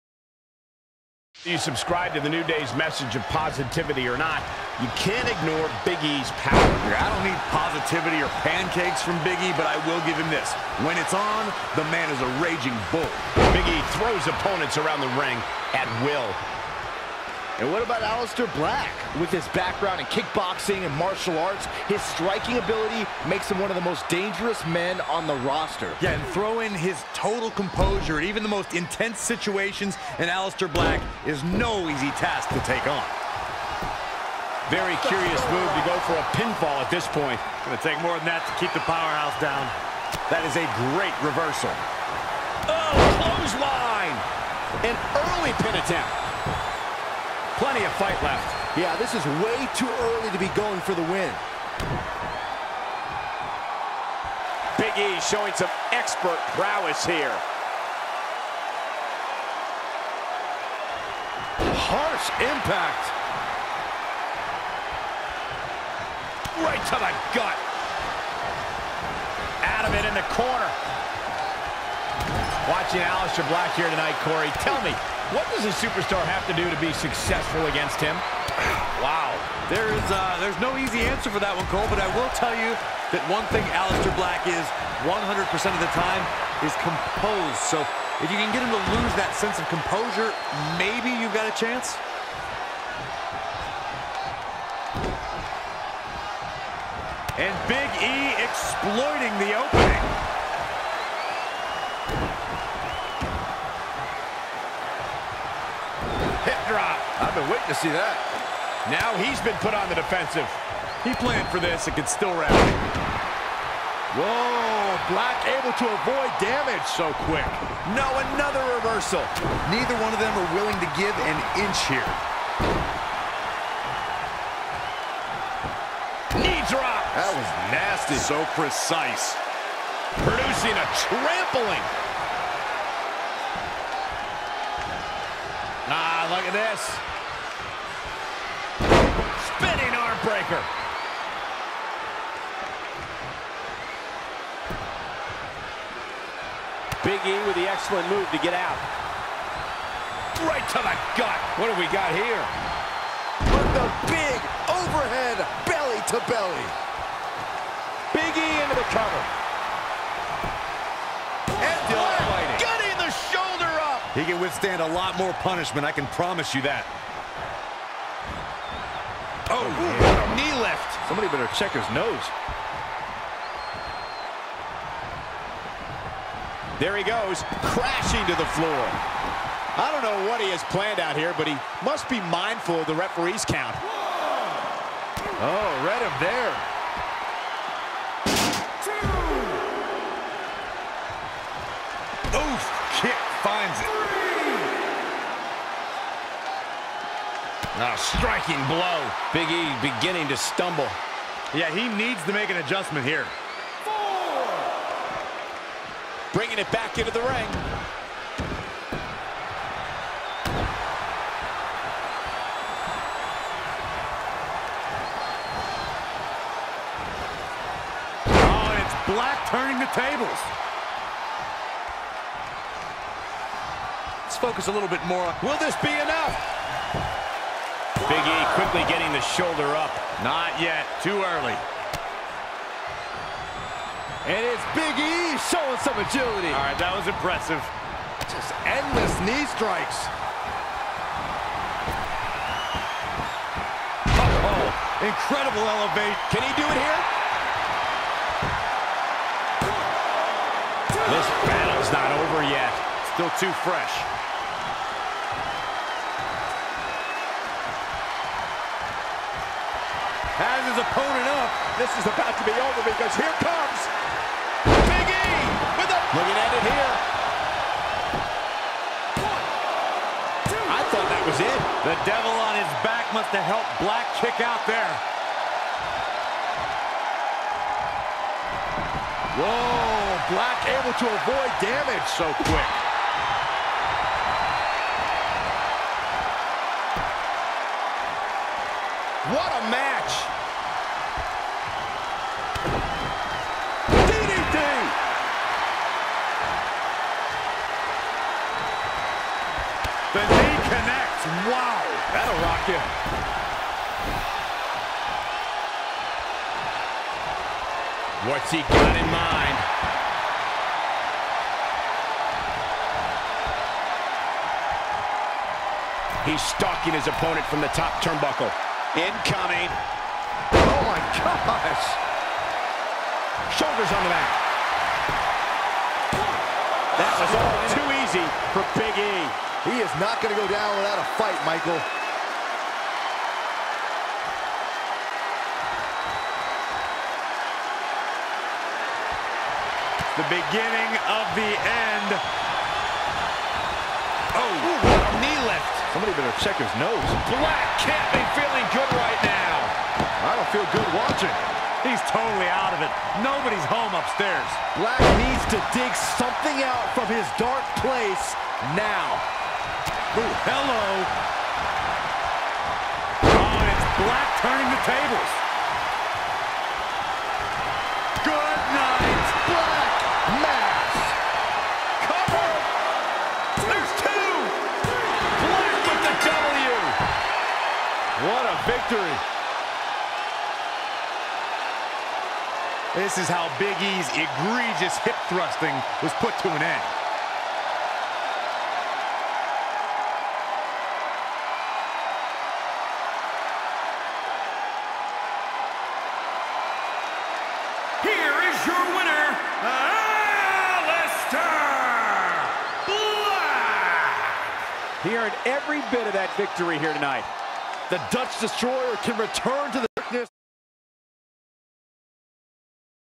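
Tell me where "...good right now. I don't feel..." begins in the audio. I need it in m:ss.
5:48.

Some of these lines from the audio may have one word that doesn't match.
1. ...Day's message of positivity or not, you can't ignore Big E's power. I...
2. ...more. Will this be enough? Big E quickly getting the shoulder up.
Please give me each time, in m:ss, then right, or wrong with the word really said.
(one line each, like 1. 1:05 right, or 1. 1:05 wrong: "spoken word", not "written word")
1. 0:02 right
2. 3:45 right.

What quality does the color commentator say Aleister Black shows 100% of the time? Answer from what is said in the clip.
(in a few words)
Composed.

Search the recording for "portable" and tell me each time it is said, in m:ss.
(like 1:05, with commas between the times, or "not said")
not said.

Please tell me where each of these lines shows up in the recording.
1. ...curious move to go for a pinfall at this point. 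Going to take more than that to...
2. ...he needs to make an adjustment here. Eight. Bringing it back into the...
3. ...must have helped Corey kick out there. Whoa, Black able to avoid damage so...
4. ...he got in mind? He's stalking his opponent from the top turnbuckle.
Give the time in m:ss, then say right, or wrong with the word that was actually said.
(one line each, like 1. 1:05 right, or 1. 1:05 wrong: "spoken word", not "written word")
1. 0:35 right
2. 3:21 wrong: "Four", not "Eight"
3. 4:33 wrong: "Black", not "Corey"
4. 5:08 right.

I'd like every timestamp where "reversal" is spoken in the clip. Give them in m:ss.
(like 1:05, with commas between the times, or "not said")
0:41, 1:58.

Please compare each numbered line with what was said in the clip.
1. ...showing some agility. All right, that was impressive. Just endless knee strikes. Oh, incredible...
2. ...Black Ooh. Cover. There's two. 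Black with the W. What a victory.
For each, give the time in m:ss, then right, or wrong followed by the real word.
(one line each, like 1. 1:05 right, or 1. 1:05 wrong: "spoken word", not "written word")
1. 3:55 right
2. 6:09 wrong: "Mass", not "Ooh".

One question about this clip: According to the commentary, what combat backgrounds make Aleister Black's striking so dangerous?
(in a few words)
Kickboxing and martial arts.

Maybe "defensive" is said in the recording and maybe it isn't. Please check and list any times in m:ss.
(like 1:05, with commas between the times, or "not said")
1:49.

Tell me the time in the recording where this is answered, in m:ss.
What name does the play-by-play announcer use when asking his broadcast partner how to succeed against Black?
1:14.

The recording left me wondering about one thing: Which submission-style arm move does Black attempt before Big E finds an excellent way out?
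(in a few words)
Spinning arm breaker.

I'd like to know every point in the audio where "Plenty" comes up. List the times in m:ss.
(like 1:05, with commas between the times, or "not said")
0:47.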